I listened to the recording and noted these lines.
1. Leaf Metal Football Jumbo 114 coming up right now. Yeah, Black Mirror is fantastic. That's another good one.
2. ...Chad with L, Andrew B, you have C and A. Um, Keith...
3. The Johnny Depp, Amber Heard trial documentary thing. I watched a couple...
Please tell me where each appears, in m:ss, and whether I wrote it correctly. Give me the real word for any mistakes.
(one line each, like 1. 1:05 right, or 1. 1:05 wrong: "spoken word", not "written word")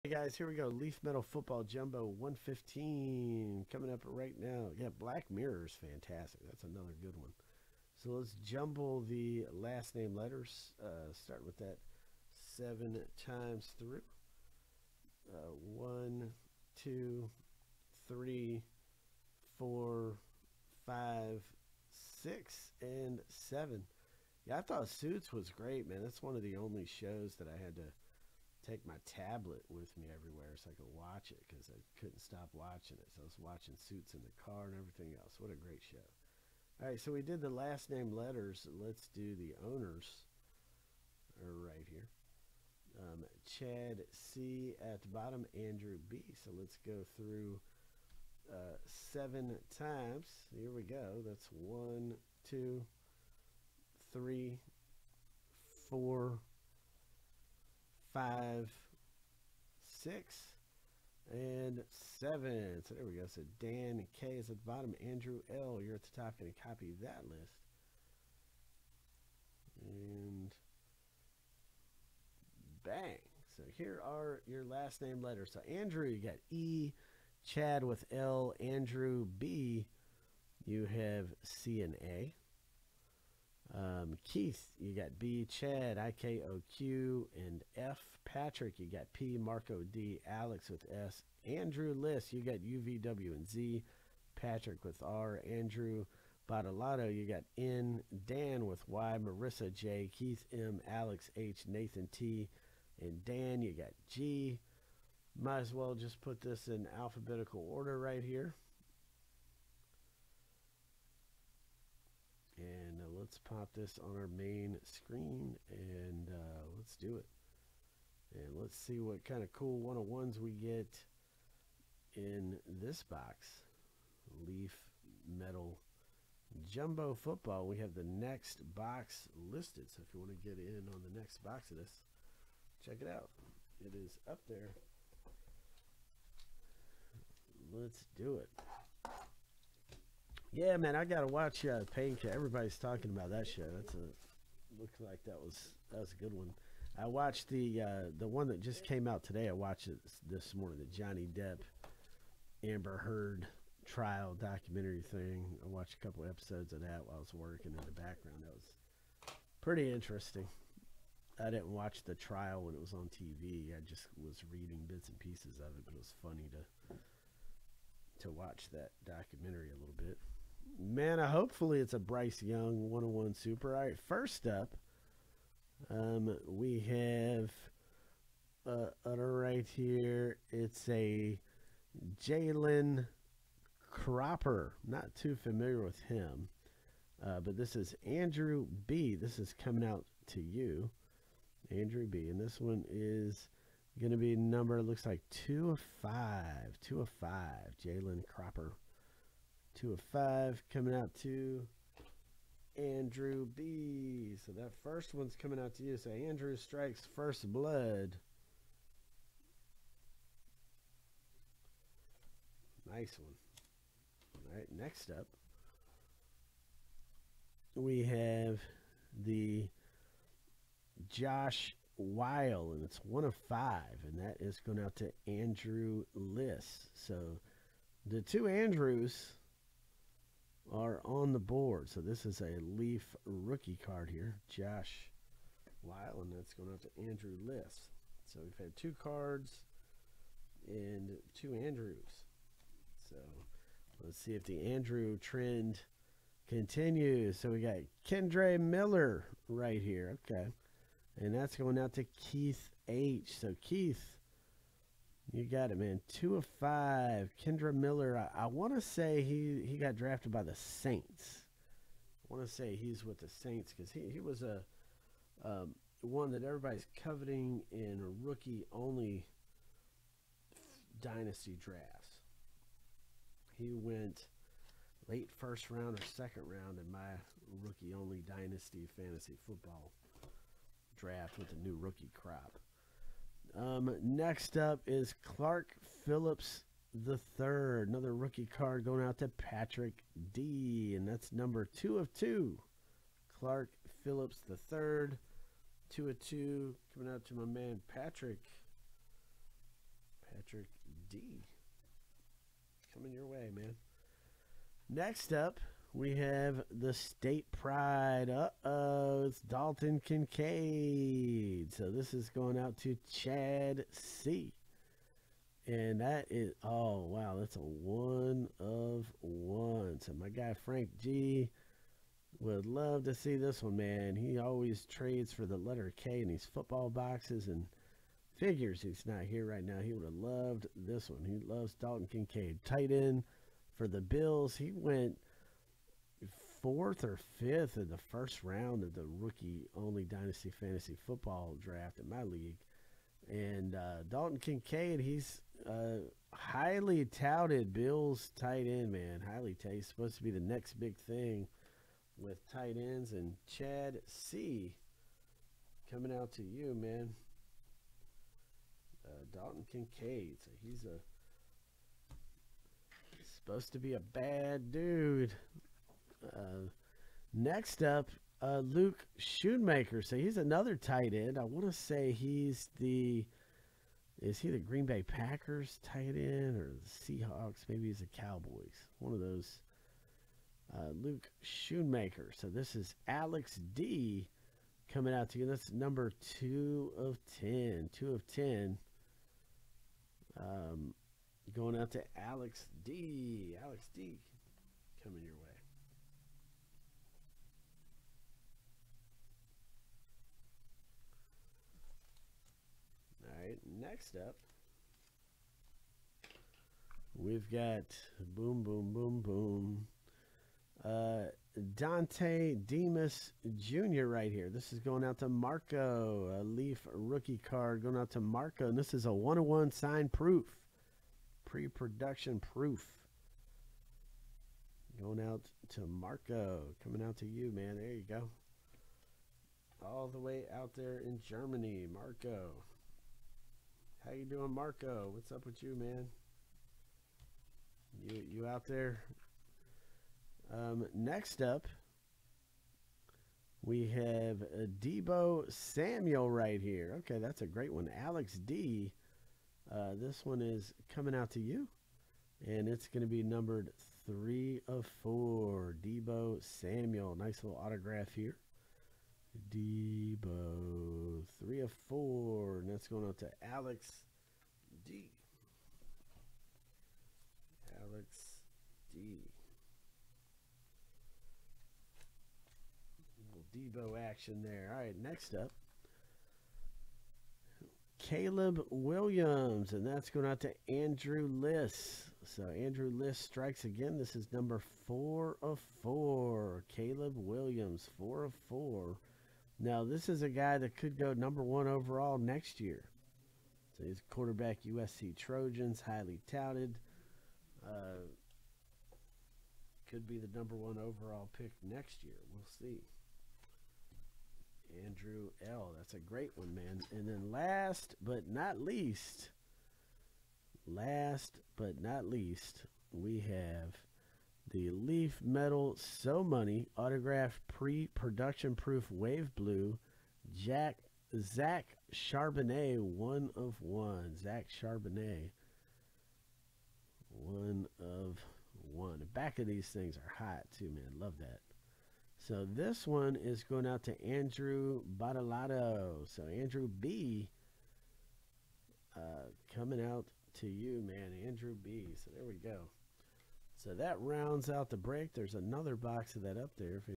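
1. 0:00 wrong: "115", not "114"
2. 1:17 right
3. 2:30 right.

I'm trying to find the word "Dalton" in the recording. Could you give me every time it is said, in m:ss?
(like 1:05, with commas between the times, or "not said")
5:09, 5:31, 5:44, 5:59.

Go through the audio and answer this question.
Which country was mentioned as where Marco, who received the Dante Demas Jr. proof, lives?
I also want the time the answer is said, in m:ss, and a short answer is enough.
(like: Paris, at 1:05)
Germany, at 7:11.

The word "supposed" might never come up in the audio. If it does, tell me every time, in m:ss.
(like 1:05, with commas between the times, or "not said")
5:49, 6:03.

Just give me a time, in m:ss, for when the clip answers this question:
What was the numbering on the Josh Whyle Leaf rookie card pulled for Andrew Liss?
3:43.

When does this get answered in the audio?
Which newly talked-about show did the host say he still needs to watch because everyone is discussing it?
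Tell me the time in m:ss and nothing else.
2:21.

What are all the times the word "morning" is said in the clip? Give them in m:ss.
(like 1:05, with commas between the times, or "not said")
2:30.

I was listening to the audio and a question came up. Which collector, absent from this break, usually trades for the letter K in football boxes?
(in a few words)
Frank G.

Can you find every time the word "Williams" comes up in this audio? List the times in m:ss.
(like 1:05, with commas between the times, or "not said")
7:58, 8:07.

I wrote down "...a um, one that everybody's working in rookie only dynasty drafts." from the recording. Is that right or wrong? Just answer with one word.
wrong.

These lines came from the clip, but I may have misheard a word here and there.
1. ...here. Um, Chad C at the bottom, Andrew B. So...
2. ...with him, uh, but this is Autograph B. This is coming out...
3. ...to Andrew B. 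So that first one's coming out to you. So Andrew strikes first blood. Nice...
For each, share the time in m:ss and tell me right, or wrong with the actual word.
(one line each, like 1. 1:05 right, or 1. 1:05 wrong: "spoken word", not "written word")
1. 0:41 right
2. 3:05 wrong: "Andrew", not "Autograph"
3. 3:21 right.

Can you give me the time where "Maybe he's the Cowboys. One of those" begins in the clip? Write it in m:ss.
6:17.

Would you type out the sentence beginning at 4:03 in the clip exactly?
So let's see if the Andrew trend continues.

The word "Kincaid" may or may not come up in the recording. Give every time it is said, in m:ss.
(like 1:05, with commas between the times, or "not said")
5:10, 5:32, 5:44, 5:59.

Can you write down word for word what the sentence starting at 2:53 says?
All right, first up, um, we have uh, right here.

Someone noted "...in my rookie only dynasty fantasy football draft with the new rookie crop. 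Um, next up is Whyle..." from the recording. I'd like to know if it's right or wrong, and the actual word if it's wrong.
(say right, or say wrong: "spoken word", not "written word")
wrong: "Clark", not "Whyle".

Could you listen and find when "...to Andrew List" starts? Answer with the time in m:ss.
3:56.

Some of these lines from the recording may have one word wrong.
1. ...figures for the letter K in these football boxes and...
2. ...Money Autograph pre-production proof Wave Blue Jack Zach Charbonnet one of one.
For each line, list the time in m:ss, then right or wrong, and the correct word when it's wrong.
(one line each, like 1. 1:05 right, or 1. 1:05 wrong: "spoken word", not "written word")
1. 5:24 wrong: "trades", not "figures"
2. 8:36 right.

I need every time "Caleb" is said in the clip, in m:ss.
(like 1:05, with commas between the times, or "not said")
7:57, 8:06.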